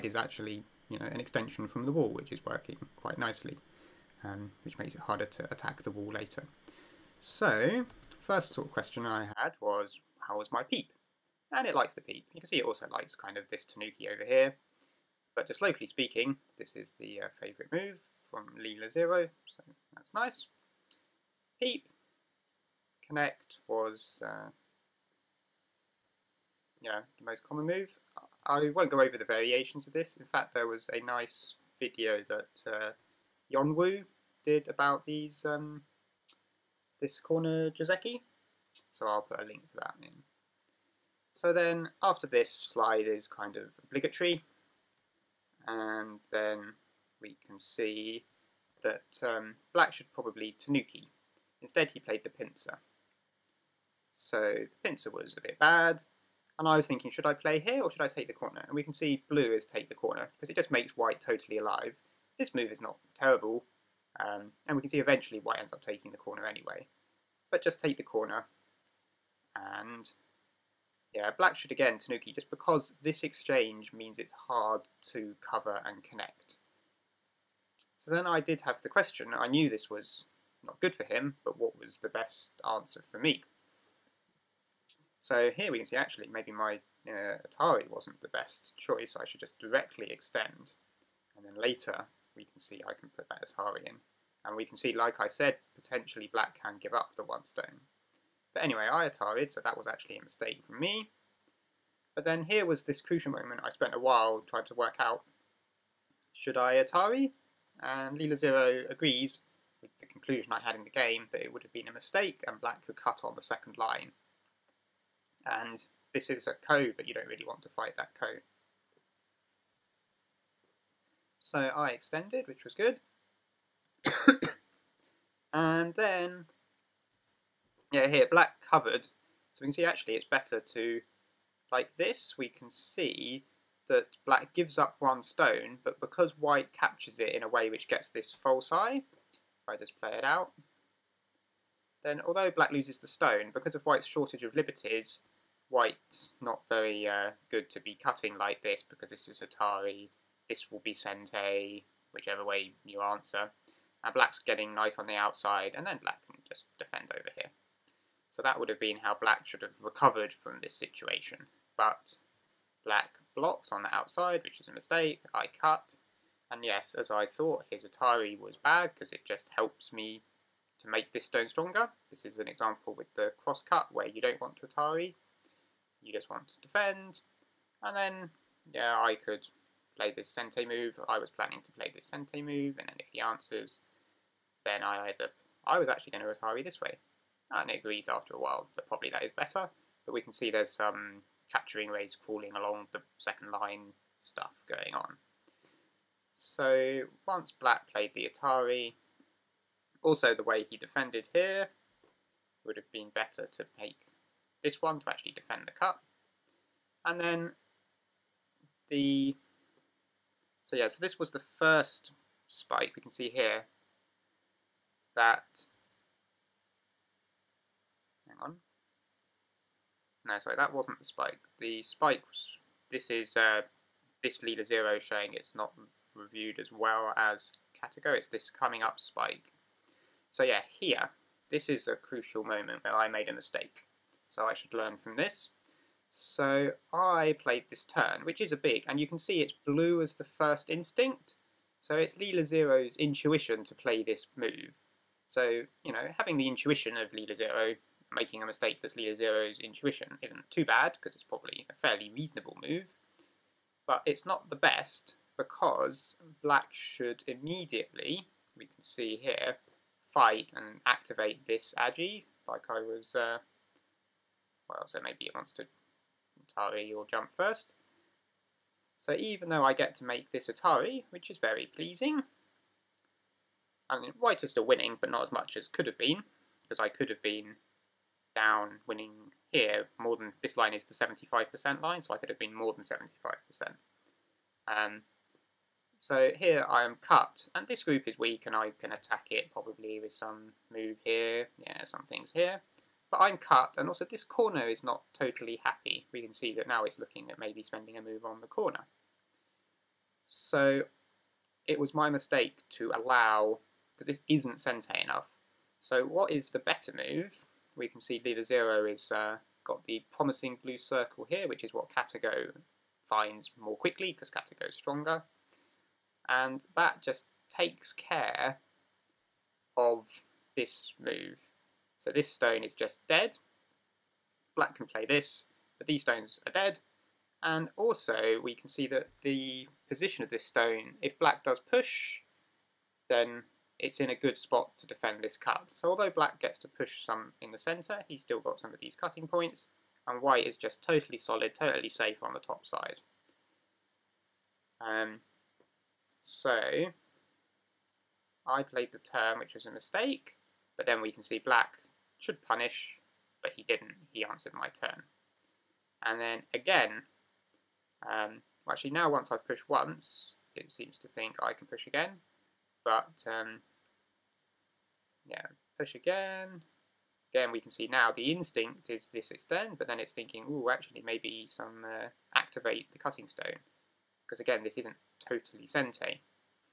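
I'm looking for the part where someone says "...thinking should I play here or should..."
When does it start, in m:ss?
0:56.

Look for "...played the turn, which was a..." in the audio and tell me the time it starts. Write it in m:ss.
5:48.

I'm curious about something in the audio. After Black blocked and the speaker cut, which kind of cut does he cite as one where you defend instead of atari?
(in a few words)
Cross cut.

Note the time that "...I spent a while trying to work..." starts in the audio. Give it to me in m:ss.
1:43.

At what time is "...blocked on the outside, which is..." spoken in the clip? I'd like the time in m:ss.
2:43.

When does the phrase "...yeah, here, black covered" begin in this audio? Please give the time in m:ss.
2:07.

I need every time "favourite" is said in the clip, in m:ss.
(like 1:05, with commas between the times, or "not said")
0:17.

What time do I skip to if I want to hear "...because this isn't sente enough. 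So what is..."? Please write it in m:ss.
5:03.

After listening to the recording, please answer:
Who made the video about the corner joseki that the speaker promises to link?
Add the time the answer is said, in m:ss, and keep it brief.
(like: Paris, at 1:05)
Yeonwoo, at 0:33.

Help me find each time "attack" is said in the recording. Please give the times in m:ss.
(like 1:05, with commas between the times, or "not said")
0:05, 4:48.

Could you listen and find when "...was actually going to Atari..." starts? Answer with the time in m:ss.
3:05.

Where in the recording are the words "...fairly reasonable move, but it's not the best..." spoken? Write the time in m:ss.
4:11.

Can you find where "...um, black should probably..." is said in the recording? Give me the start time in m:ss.
0:49.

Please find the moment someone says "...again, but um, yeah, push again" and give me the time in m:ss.
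6:01.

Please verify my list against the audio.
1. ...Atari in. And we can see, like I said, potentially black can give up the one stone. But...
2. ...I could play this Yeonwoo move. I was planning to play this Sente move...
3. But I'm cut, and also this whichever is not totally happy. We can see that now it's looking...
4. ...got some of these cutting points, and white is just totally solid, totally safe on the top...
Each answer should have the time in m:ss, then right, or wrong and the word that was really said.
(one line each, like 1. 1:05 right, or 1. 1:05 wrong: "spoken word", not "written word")
1. 1:33 right
2. 2:58 wrong: "Sente", not "Yeonwoo"
3. 4:53 wrong: "corner", not "whichever"
4. 5:38 right.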